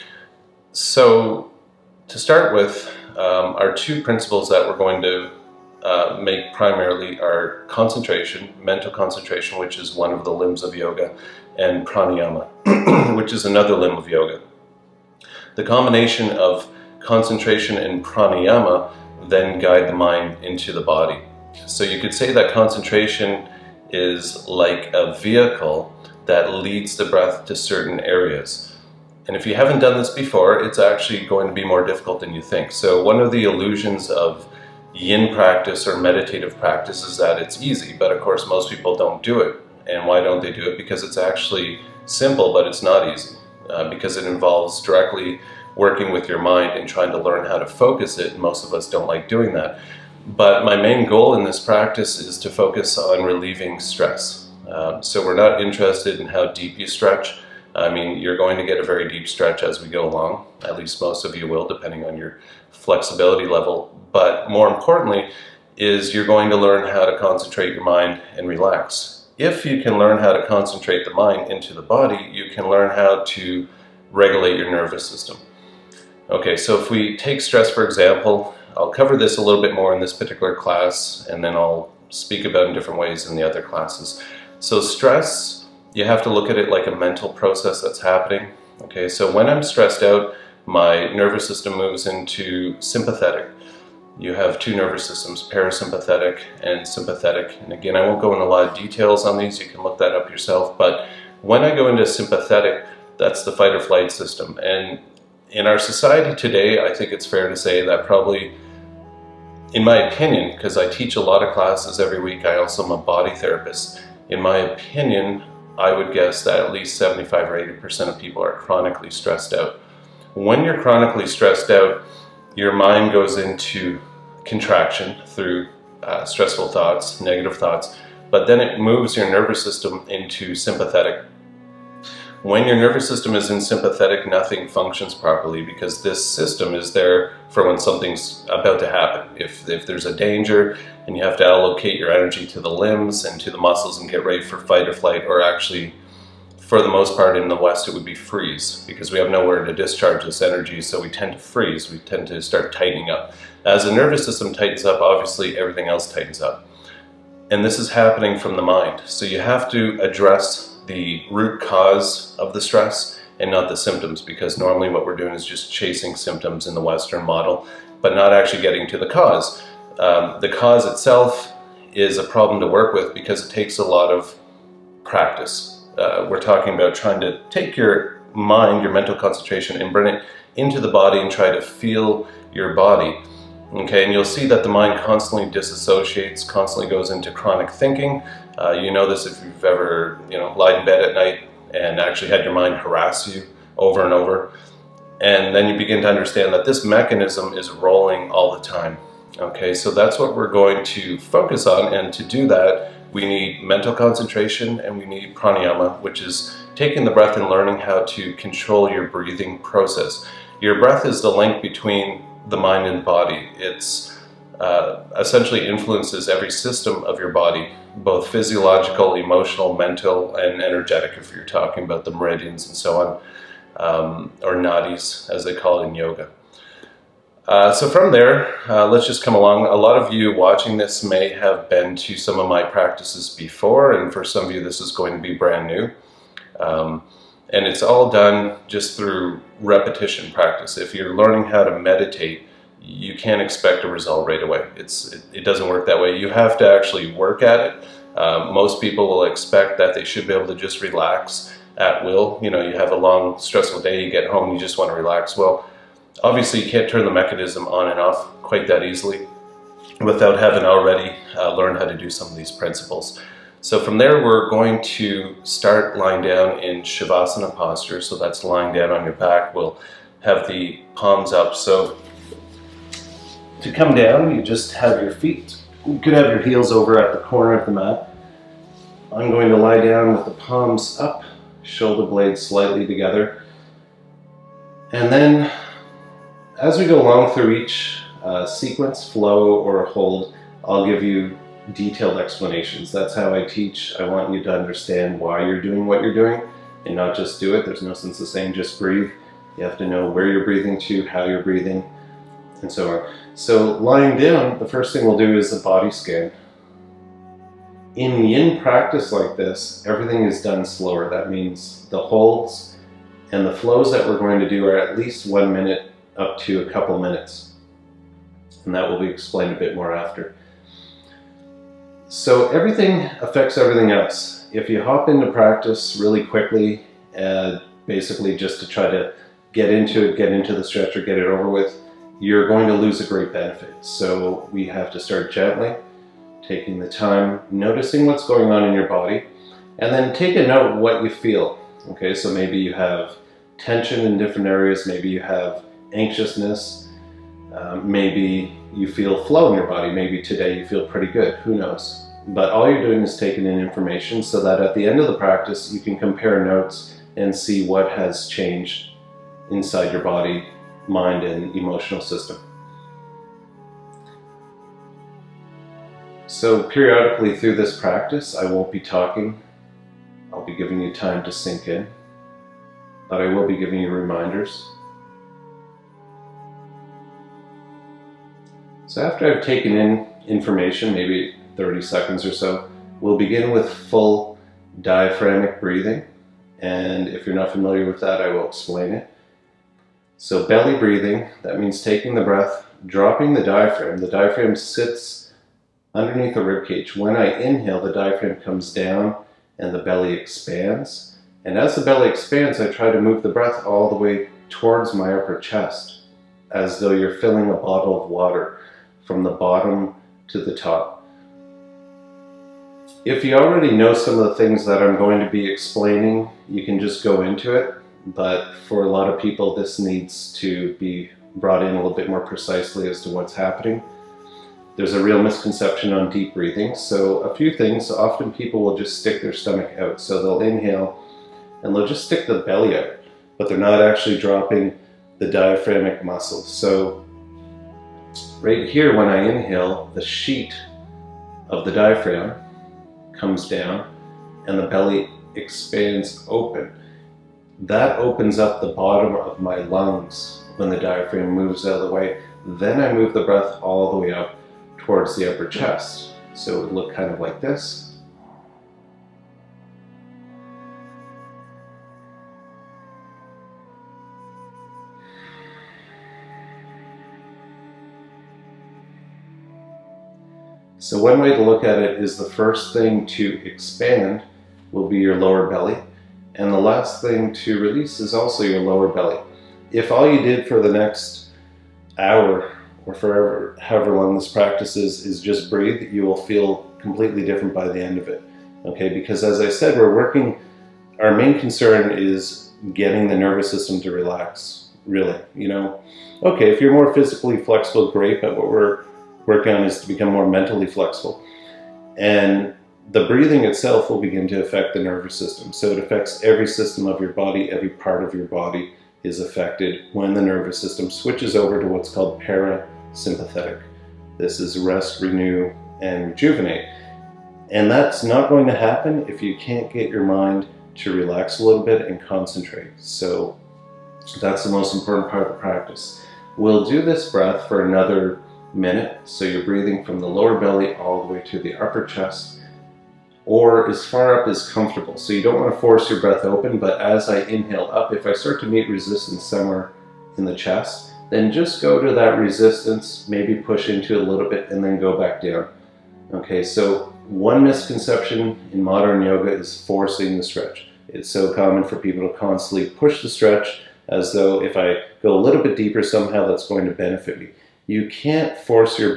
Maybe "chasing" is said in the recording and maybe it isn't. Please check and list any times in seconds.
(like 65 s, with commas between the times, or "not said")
165 s.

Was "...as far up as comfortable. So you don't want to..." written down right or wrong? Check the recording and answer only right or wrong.
right.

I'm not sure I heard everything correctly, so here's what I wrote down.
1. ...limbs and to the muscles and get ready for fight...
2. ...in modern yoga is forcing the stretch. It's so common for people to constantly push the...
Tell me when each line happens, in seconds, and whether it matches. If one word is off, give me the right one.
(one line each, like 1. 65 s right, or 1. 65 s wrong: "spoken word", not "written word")
1. 142 s right
2. 548 s right.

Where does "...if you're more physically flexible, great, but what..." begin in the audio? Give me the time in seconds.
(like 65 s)
496 s.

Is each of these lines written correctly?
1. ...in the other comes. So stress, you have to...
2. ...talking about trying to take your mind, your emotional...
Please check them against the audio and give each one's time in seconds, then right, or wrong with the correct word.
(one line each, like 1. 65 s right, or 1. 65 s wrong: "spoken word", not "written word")
1. 83 s wrong: "classes", not "comes"
2. 176 s wrong: "mental", not "emotional".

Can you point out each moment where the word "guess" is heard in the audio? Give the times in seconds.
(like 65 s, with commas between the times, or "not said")
116 s.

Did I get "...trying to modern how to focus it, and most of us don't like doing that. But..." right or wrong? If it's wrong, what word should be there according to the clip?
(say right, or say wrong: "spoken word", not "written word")
wrong: "learn", not "modern".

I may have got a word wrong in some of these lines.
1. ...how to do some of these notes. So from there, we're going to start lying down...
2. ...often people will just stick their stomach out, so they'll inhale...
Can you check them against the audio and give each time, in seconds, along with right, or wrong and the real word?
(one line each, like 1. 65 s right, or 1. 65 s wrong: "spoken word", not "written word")
1. 261 s wrong: "principles", not "notes"
2. 427 s right.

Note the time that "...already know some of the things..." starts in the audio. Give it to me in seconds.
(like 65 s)
413 s.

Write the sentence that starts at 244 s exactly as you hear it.
It's, it, it doesn't work that way.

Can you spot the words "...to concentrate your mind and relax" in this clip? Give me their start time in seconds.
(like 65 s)
67 s.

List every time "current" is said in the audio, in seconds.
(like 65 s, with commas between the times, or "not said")
not said.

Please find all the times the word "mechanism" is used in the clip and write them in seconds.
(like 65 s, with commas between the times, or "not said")
196 s, 257 s.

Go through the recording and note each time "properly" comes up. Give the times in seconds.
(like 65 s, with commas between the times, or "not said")
135 s.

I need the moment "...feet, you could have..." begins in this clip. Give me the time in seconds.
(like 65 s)
275 s.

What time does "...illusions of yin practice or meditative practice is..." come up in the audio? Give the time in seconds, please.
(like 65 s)
33 s.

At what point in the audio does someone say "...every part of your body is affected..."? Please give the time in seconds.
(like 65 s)
507 s.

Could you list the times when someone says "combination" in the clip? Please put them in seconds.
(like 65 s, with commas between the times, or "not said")
15 s.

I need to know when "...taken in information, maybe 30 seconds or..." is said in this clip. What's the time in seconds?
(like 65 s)
379 s.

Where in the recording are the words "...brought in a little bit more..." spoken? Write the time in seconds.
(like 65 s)
421 s.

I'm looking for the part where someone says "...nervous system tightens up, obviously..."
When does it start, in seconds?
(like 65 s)
153 s.